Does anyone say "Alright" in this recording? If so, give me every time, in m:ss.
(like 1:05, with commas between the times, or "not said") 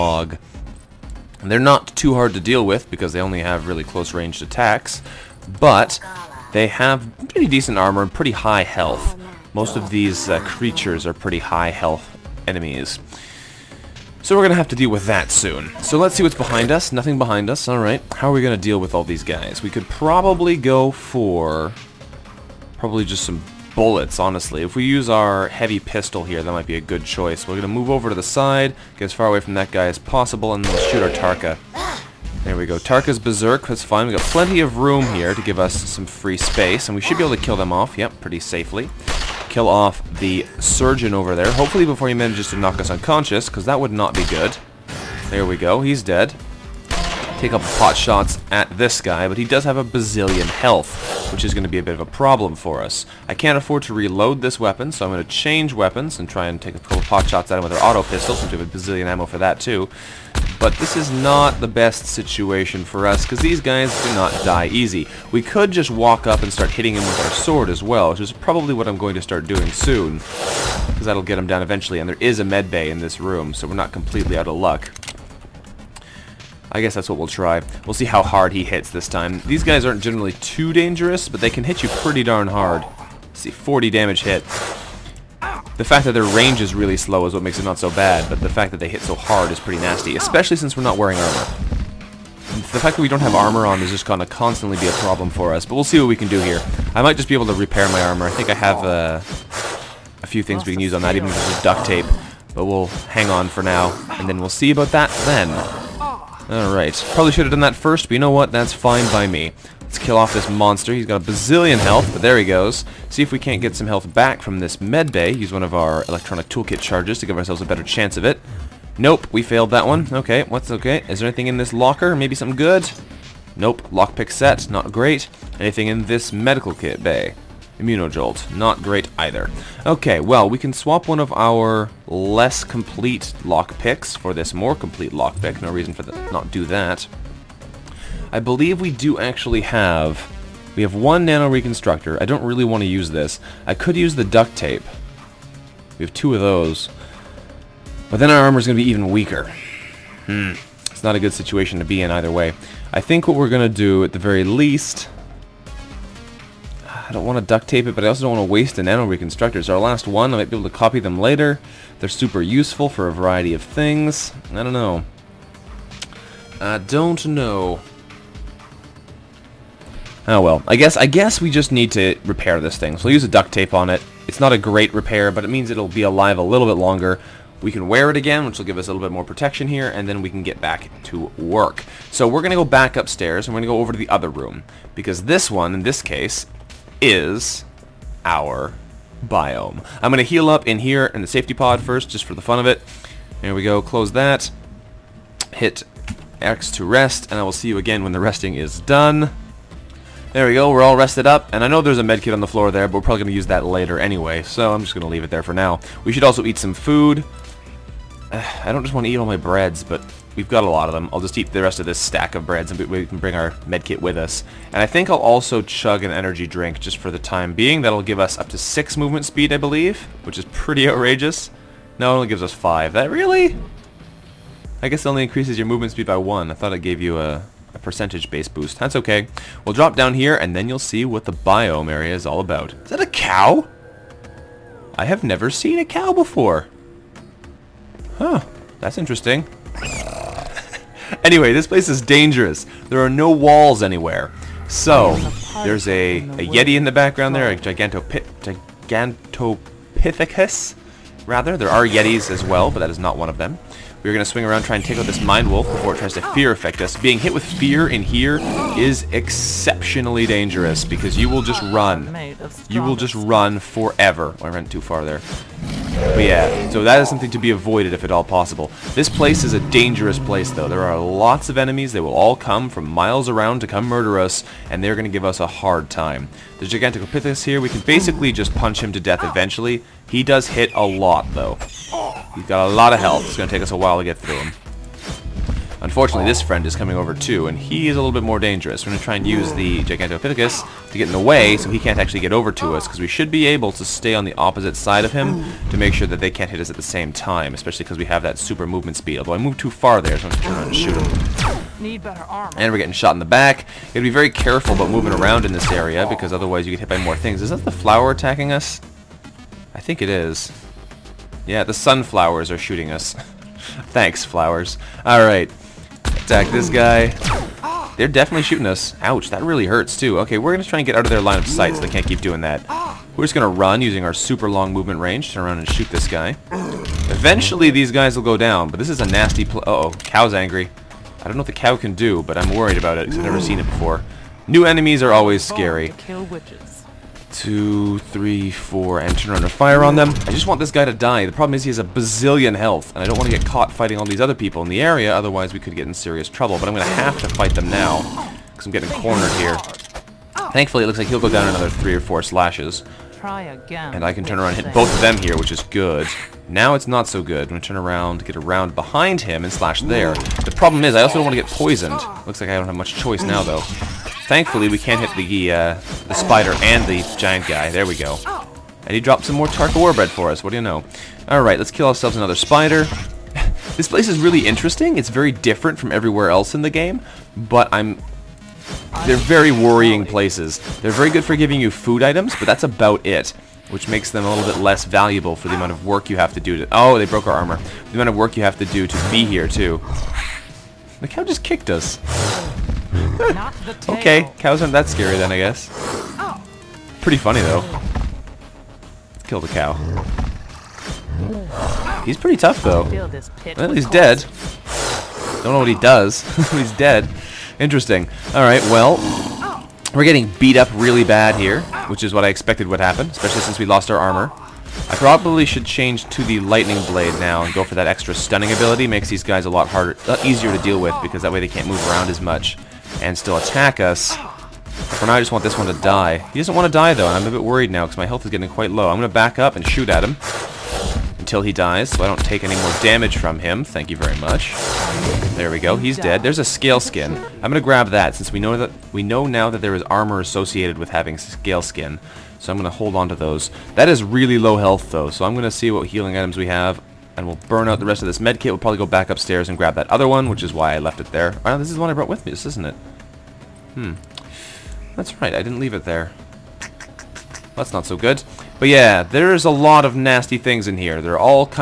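0:17, 1:46, 5:15, 6:11, 6:48.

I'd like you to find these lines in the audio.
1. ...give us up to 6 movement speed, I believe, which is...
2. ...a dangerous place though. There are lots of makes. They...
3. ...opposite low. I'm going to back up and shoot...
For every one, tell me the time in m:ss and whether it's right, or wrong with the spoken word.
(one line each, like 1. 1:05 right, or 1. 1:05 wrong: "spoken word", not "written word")
1. 3:38 right
2. 4:29 wrong: "enemies", not "makes"
3. 7:08 wrong: "quite", not "opposite".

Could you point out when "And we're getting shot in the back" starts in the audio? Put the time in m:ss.
5:02.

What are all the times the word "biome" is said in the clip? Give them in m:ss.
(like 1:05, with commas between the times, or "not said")
3:09, 3:51.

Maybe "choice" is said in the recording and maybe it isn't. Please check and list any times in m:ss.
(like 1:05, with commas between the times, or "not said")
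0:27, 6:02.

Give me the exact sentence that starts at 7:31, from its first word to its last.
Oh, this is the one I brought with me, this isn't it?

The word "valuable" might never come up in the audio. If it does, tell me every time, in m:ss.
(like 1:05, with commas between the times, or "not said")
6:24.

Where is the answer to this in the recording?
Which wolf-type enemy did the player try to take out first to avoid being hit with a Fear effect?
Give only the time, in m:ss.
4:15.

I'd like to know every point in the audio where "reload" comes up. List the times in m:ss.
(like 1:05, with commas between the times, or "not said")
0:53.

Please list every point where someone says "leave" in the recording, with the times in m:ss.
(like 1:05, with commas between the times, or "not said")
3:25, 7:35.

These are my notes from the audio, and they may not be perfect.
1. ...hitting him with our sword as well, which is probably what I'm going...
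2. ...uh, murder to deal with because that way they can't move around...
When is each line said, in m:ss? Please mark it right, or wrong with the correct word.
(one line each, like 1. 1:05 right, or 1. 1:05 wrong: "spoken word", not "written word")
1. 1:06 right
2. 7:00 wrong: "easier", not "murder".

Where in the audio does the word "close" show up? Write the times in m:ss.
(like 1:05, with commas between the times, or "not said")
0:03, 3:13.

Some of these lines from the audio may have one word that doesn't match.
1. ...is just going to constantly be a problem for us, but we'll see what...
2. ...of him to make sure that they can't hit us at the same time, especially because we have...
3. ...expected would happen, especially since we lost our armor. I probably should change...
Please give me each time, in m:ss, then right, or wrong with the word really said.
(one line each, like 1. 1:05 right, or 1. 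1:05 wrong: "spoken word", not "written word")
1. 1:33 right
2. 4:55 right
3. 6:52 right.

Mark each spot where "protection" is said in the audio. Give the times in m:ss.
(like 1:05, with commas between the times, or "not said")
2:59.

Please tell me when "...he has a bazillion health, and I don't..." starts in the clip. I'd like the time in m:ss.
5:41.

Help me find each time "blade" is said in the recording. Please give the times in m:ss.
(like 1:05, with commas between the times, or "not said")
6:56.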